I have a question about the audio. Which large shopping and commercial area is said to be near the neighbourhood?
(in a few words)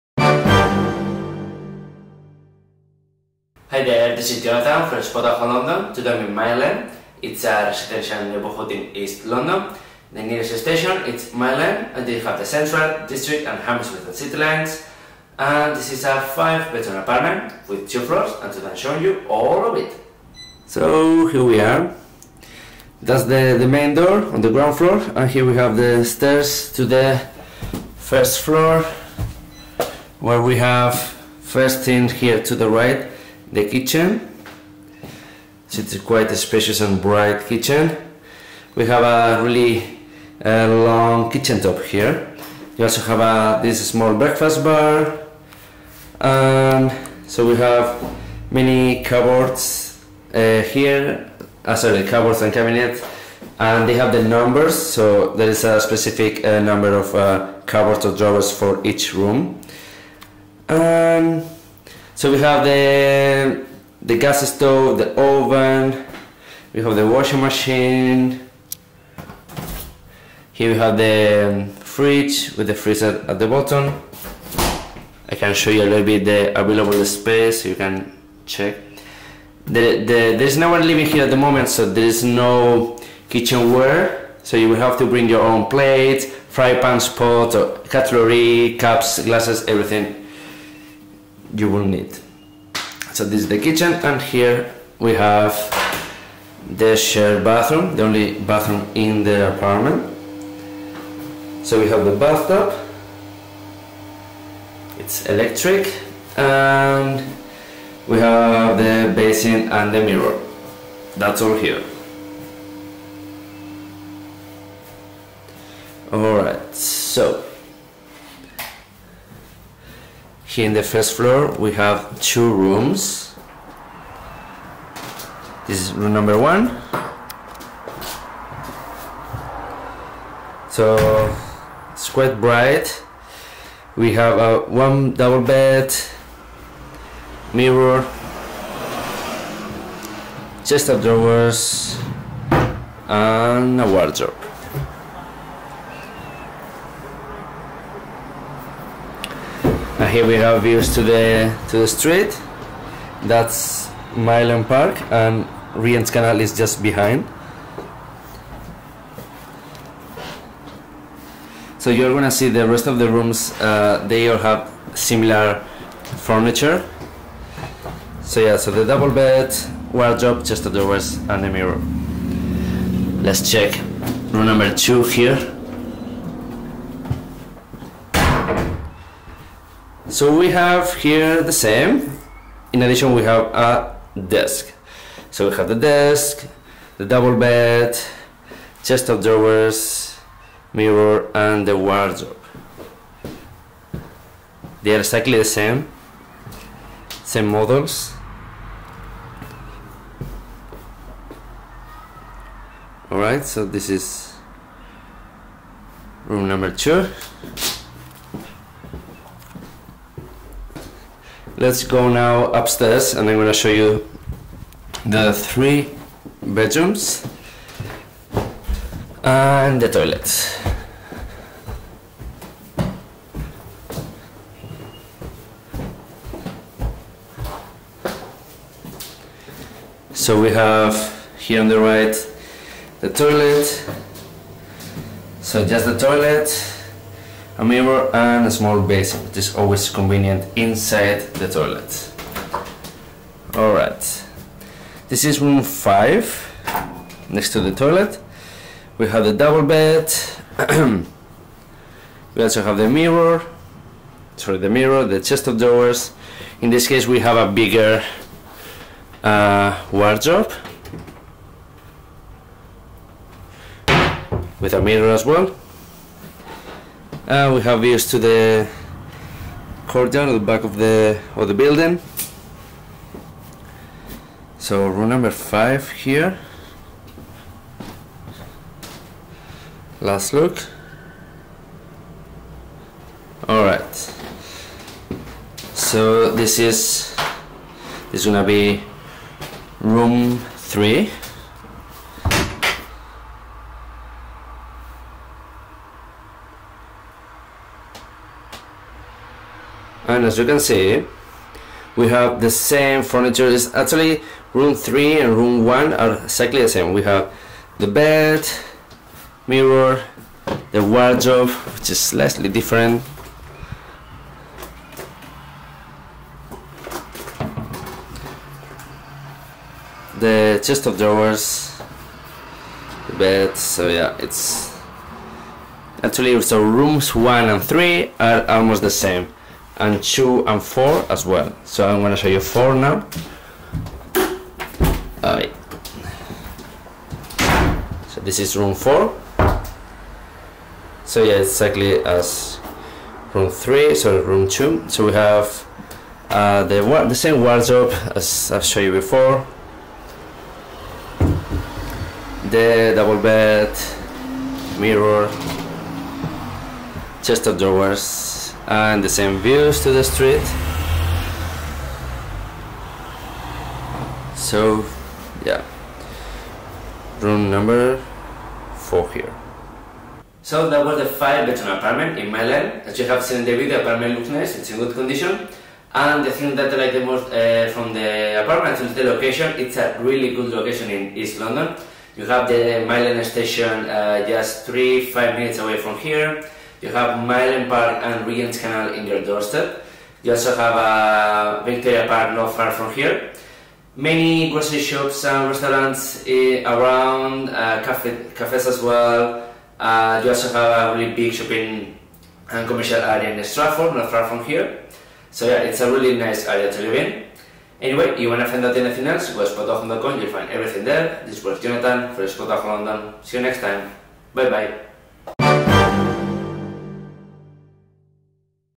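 Stratford.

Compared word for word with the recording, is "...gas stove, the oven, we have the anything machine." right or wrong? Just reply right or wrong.
wrong.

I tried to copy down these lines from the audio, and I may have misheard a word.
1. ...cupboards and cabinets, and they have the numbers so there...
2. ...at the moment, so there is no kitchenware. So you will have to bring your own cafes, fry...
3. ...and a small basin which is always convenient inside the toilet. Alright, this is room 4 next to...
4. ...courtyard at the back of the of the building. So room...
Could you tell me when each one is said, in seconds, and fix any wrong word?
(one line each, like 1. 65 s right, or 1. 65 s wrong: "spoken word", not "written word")
1. 52 s right
2. 81 s wrong: "plates", not "cafes"
3. 238 s wrong: "5", not "4"
4. 269 s right.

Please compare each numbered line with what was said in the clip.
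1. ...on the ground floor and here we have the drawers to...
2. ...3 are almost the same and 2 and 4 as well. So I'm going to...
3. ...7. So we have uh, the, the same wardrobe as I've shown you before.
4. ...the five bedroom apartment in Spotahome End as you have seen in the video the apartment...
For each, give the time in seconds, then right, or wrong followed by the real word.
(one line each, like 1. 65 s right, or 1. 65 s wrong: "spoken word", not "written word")
1. 24 s wrong: "stairs", not "drawers"
2. 327 s right
3. 344 s wrong: "2", not "7"
4. 370 s wrong: "Mile", not "Spotahome".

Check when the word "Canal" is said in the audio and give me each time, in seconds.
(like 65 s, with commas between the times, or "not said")
156 s, 388 s.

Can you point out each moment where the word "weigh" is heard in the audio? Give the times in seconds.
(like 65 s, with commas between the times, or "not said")
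not said.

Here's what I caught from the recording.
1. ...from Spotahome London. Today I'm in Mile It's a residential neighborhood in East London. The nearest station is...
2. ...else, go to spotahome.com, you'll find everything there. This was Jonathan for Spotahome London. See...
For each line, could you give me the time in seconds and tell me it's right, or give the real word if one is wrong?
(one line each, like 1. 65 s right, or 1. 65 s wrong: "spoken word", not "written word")
1. 4 s right
2. 409 s right.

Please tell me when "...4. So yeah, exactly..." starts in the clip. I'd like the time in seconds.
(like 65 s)
338 s.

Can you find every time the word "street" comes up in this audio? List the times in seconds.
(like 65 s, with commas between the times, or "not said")
151 s, 360 s.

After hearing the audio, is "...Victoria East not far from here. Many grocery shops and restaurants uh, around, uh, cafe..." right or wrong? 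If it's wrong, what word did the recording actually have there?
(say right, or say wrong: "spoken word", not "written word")
wrong: "Park", not "East".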